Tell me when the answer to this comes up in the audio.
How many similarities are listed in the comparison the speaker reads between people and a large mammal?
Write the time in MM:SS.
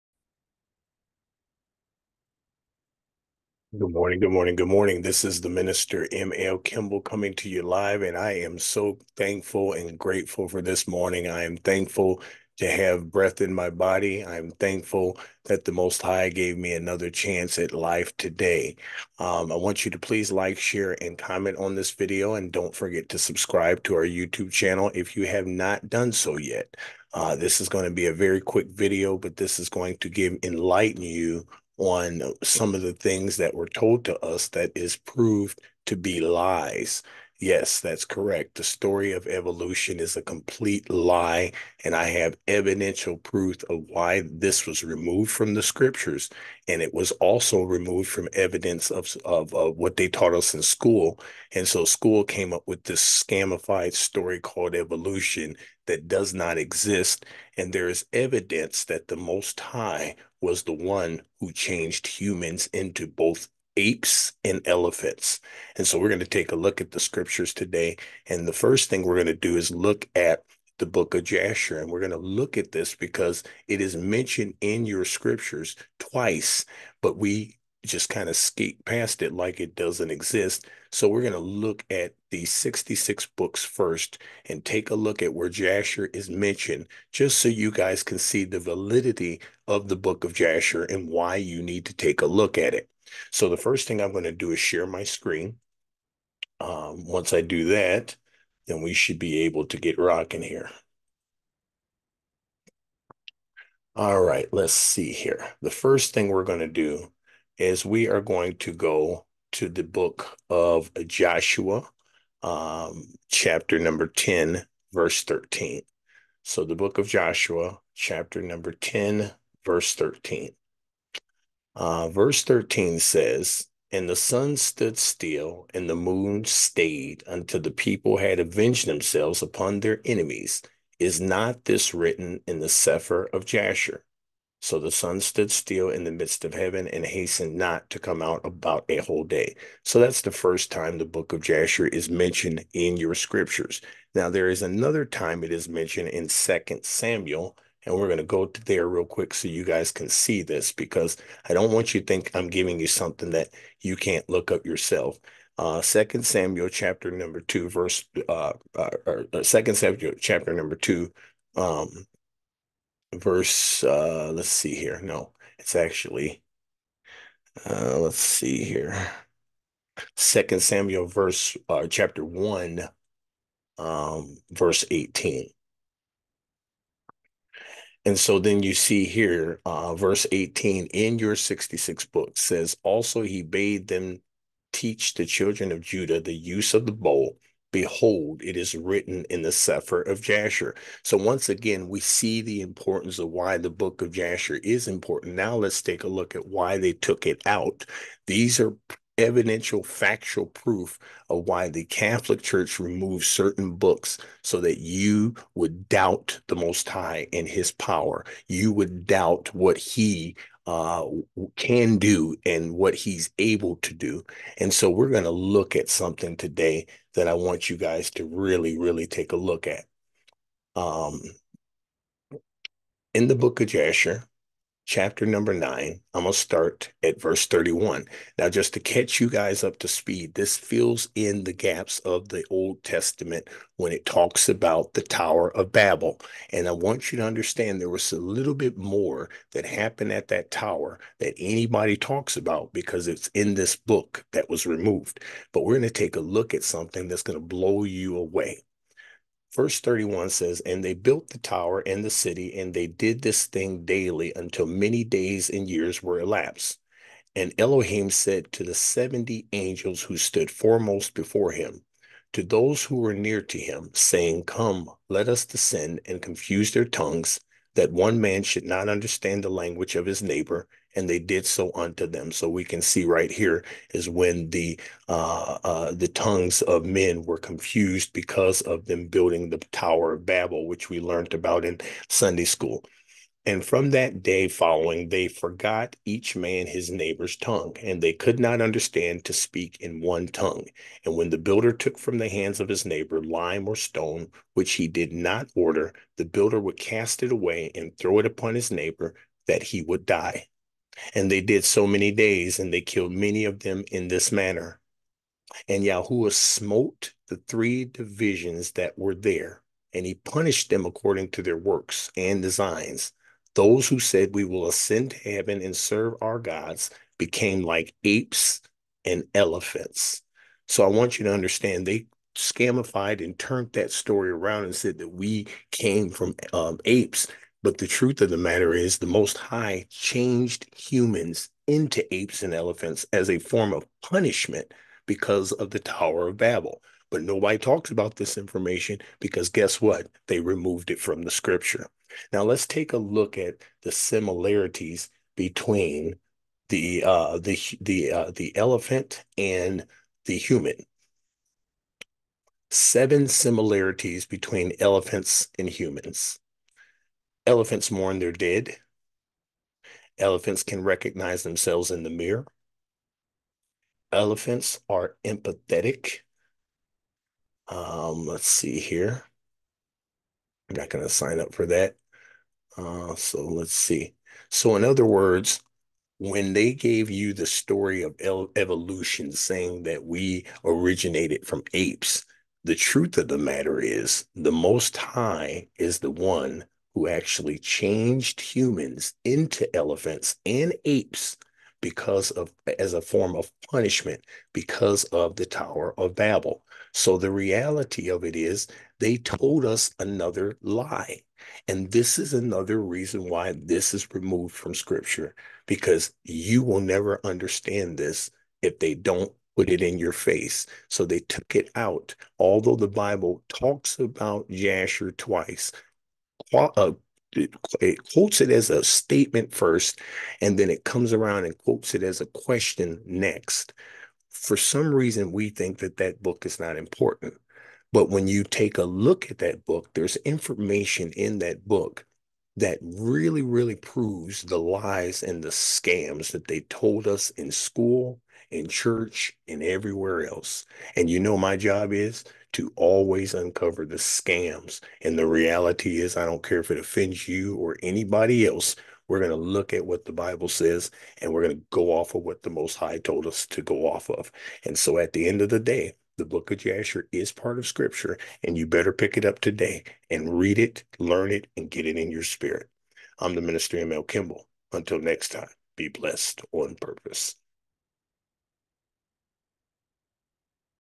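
05:52.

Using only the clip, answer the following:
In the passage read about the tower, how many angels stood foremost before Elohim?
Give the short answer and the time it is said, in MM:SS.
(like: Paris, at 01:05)
70, at 04:18.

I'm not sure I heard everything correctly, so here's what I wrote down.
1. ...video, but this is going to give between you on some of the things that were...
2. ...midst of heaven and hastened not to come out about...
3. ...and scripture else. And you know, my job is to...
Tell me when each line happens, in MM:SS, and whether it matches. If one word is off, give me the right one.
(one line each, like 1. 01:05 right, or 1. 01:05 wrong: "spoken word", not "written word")
1. 00:28 wrong: "enlighten", not "between"
2. 02:16 right
3. 07:19 wrong: "everywhere", not "scripture".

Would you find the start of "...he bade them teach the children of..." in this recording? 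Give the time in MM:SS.
03:03.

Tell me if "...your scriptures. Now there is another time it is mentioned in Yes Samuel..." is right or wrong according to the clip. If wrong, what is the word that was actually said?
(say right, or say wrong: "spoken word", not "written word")
wrong: "Second", not "Yes".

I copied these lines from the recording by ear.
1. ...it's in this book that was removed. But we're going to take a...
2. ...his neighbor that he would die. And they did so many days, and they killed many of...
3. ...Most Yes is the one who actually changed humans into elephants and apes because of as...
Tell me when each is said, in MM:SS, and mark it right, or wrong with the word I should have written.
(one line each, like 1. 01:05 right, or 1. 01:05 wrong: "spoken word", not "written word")
1. 04:03 right
2. 04:58 right
3. 06:24 wrong: "High", not "Yes".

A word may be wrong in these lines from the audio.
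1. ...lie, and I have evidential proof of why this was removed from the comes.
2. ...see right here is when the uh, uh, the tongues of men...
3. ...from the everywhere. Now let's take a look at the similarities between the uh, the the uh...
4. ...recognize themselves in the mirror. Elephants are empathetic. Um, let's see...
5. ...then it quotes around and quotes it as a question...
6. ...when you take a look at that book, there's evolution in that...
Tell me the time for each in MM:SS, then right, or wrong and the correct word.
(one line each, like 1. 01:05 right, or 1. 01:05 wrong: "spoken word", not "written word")
1. 00:40 wrong: "scriptures", not "comes"
2. 04:32 right
3. 05:40 wrong: "scripture", not "everywhere"
4. 06:00 right
5. 07:00 wrong: "comes", not "quotes"
6. 07:08 wrong: "information", not "evolution".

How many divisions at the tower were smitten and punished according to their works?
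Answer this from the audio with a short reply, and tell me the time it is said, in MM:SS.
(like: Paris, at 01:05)
3, at 05:07.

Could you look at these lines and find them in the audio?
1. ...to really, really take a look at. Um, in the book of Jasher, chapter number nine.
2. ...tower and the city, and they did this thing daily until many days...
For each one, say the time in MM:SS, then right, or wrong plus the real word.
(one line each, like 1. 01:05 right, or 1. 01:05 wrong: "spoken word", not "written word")
1. 03:38 right
2. 04:11 right.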